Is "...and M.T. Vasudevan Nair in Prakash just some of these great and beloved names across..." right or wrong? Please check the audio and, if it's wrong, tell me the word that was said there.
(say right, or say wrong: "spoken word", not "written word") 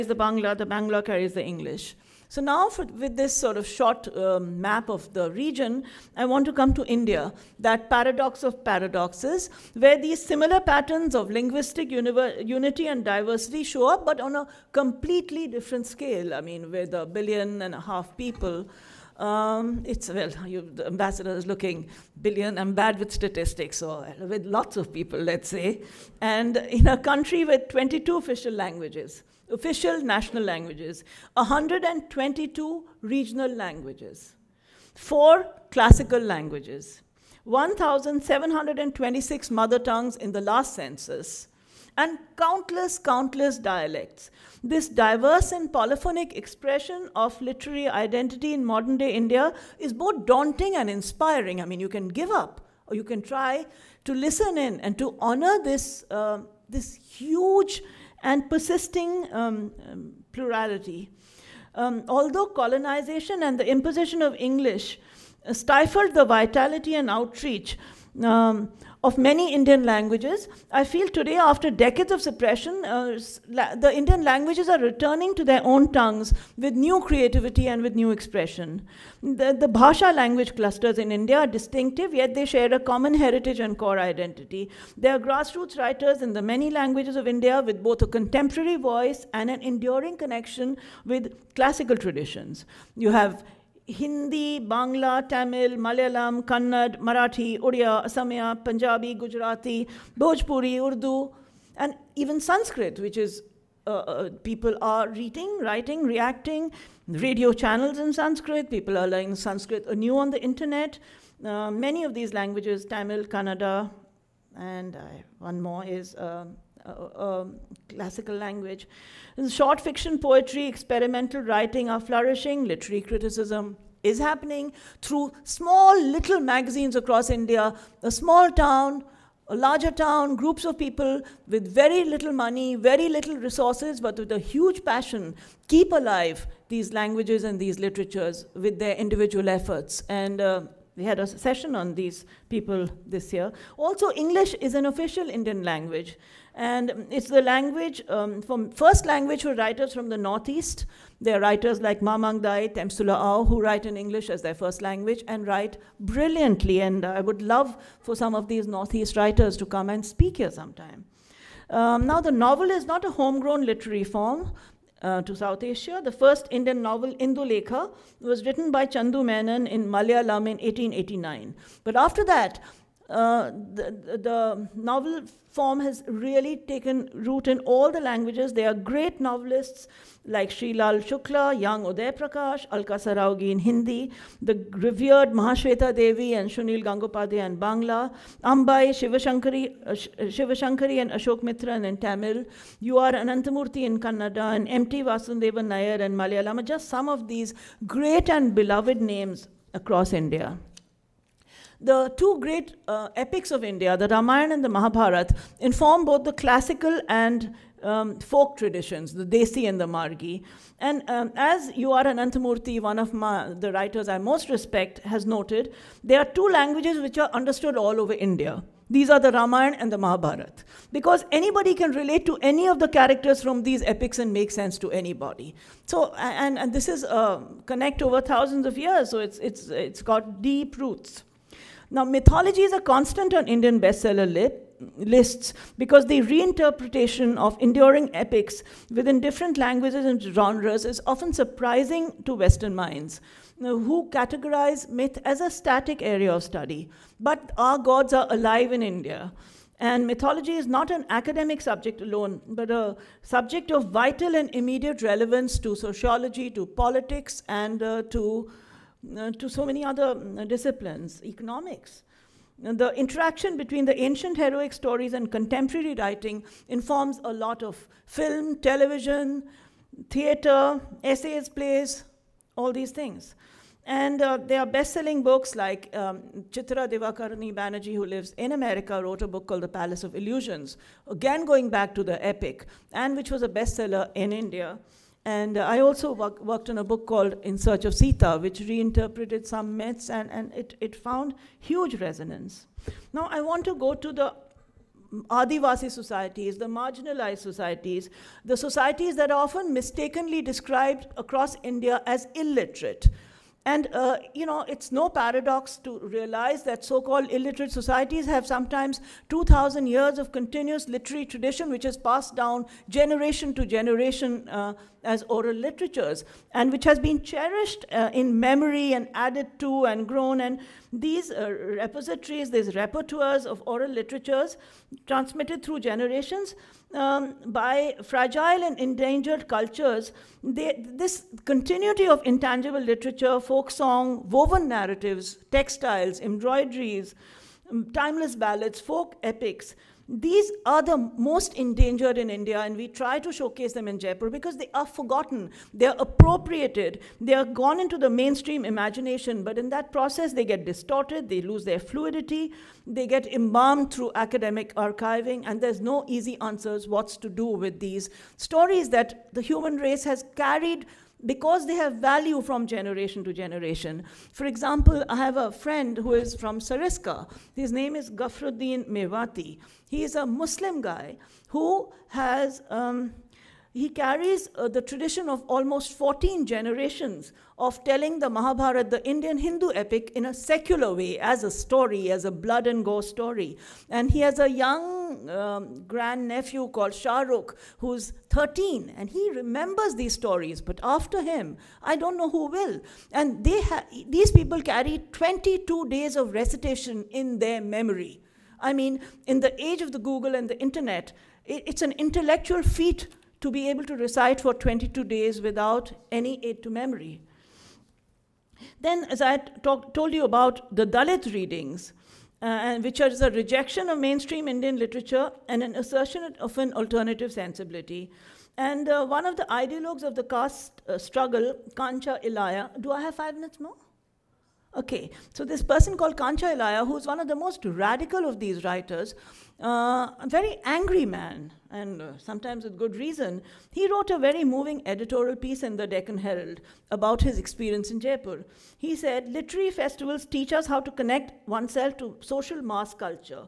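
wrong: "Malayalam", not "Prakash".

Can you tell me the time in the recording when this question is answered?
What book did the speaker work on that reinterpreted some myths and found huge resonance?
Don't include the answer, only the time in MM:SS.
04:47.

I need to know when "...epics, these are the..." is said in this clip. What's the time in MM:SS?
05:39.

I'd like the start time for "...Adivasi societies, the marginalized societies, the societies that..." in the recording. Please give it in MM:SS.
04:55.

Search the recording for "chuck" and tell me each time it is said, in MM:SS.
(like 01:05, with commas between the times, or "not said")
not said.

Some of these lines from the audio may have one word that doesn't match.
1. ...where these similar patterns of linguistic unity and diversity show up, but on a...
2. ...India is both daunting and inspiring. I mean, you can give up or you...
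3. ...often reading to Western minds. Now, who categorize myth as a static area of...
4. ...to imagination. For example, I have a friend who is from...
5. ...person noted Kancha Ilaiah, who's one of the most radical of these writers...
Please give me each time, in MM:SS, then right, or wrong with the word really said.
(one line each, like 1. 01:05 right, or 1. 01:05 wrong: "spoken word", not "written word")
1. 00:09 right
2. 00:49 right
3. 04:01 wrong: "surprising", not "reading"
4. 06:03 wrong: "generation", not "imagination"
5. 07:05 wrong: "called", not "noted".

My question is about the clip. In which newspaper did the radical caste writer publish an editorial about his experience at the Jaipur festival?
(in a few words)
Deccan Herald.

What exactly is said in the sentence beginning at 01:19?
The, the Bhasha language clusters in India are distinctive, yet they share a common heritage and core identity.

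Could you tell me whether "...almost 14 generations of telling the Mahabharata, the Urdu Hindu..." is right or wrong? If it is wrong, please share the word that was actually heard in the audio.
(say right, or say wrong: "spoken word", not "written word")
wrong: "Indian", not "Urdu".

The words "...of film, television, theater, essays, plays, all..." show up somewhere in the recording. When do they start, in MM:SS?
04:27.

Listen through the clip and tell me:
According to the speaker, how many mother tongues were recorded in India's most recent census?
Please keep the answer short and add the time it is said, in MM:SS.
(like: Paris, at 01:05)
1726, at 00:37.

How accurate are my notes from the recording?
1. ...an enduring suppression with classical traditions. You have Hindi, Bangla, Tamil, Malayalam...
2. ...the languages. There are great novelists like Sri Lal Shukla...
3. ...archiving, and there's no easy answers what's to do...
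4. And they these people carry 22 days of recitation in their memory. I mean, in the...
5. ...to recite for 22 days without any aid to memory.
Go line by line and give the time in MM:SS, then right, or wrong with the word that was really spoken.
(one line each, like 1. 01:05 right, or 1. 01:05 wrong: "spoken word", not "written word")
1. 01:29 wrong: "connection", not "suppression"
2. 02:57 right
3. 05:54 right
4. 06:33 right
5. 06:43 right.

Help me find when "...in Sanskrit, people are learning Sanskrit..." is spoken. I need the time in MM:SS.
01:47.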